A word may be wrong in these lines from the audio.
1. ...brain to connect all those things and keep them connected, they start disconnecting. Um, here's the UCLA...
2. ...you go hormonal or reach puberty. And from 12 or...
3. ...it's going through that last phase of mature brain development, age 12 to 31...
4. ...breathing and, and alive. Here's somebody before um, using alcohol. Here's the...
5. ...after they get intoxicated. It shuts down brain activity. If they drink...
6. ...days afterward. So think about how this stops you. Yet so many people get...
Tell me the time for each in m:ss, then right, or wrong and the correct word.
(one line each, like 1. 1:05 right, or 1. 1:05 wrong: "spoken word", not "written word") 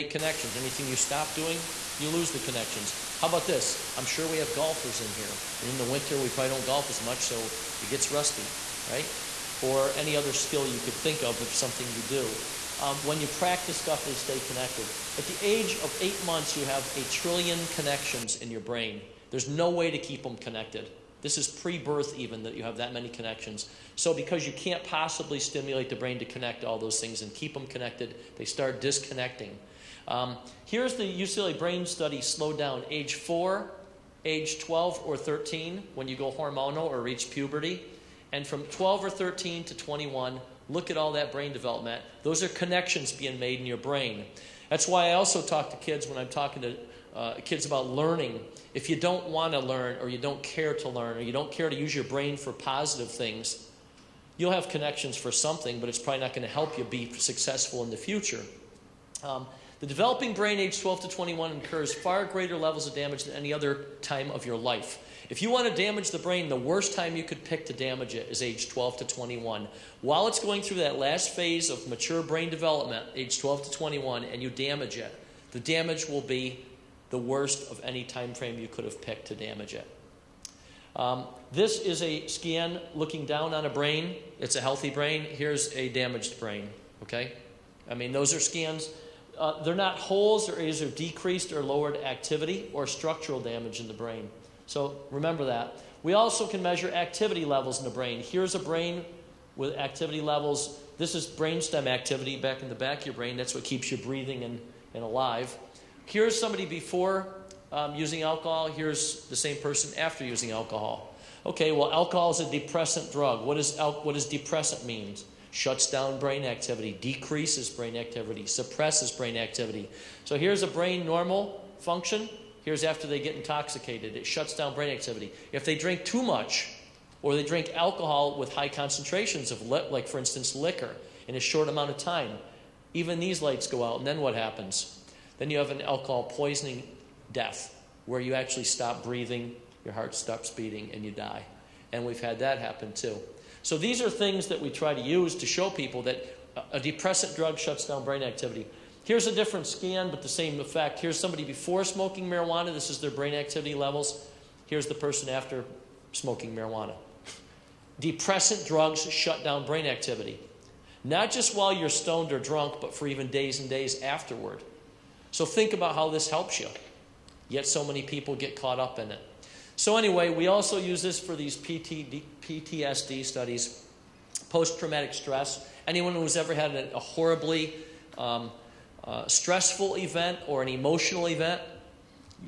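1. 0:25 right
2. 0:36 right
3. 1:10 wrong: "21", not "31"
4. 1:43 right
5. 2:02 right
6. 2:43 wrong: "helps", not "stops".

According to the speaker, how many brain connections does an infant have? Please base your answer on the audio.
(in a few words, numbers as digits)
a trillion.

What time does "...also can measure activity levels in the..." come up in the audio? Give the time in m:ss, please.
1:36.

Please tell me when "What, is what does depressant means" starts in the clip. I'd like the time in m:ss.
1:53.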